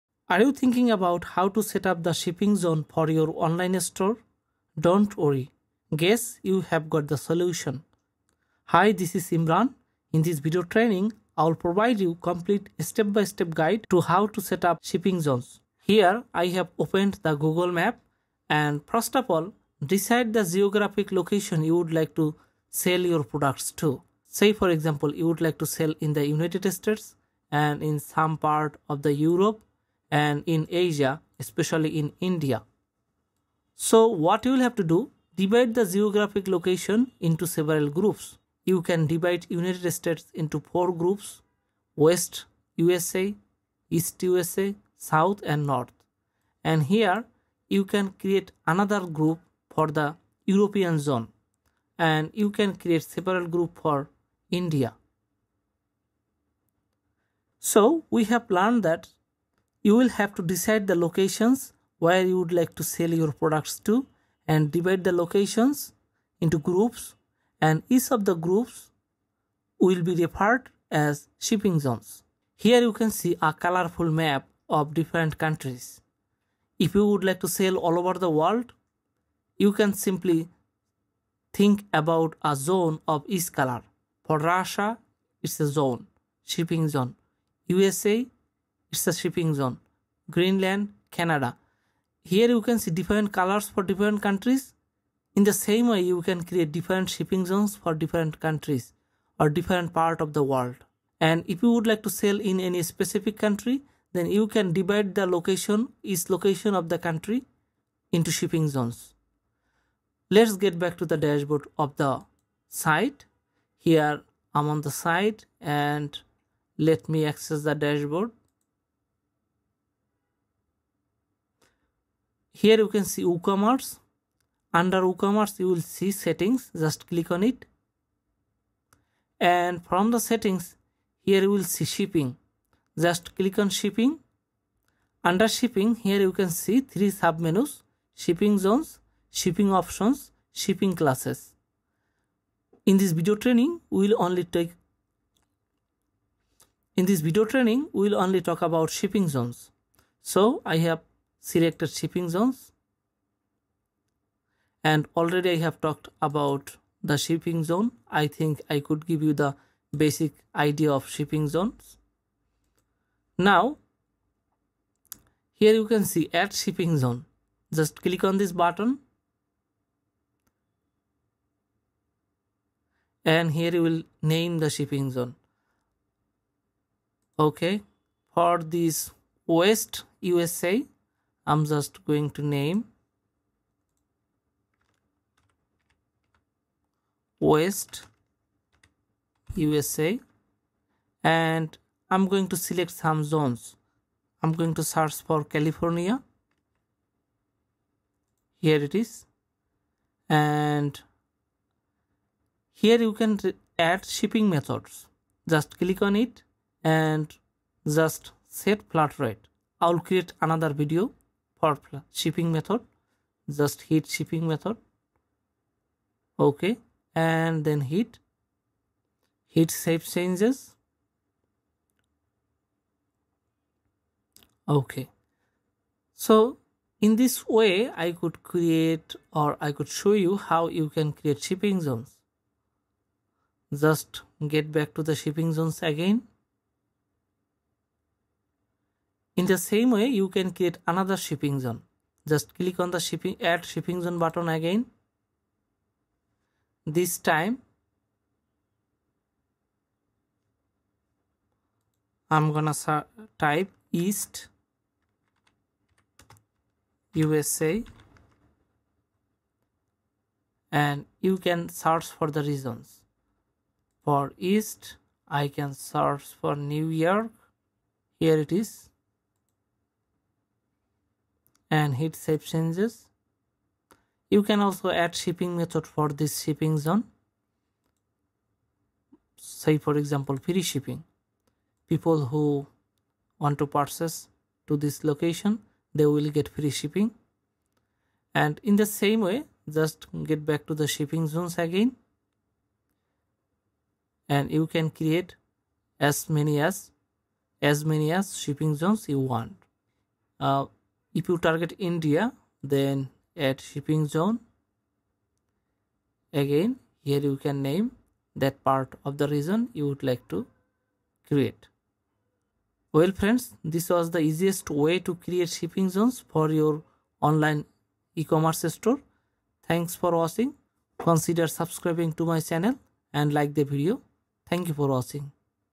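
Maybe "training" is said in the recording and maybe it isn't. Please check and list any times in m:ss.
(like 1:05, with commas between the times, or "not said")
0:10, 2:23, 2:27.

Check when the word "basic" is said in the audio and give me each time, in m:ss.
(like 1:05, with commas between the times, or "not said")
2:40.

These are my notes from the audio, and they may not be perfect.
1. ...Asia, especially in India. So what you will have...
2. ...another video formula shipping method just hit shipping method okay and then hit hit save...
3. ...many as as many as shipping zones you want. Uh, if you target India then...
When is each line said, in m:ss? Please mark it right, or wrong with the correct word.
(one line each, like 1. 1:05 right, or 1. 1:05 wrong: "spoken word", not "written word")
1. 0:30 right
2. 3:30 right
3. 4:56 right.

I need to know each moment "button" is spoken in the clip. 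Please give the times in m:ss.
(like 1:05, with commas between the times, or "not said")
2:48, 4:04.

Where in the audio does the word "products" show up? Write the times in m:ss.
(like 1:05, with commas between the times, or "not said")
0:23, 1:03.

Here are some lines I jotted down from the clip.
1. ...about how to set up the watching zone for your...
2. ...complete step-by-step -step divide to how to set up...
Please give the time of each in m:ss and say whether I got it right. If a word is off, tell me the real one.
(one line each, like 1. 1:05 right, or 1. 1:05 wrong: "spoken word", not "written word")
1. 0:00 wrong: "shipping", not "watching"
2. 0:12 wrong: "guide", not "divide".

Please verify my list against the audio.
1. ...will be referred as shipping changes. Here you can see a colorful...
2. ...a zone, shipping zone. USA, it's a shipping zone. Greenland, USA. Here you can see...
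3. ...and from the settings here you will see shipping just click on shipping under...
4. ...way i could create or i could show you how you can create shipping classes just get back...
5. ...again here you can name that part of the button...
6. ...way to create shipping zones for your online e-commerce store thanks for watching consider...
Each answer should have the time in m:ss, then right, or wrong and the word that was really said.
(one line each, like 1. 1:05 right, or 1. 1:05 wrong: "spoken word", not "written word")
1. 1:09 wrong: "zones", not "changes"
2. 1:25 wrong: "Canada", not "USA"
3. 2:09 right
4. 3:47 wrong: "zones", not "classes"
5. 5:06 wrong: "region", not "button"
6. 5:14 right.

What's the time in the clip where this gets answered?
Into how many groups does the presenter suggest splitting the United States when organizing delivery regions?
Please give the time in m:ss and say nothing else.
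0:40.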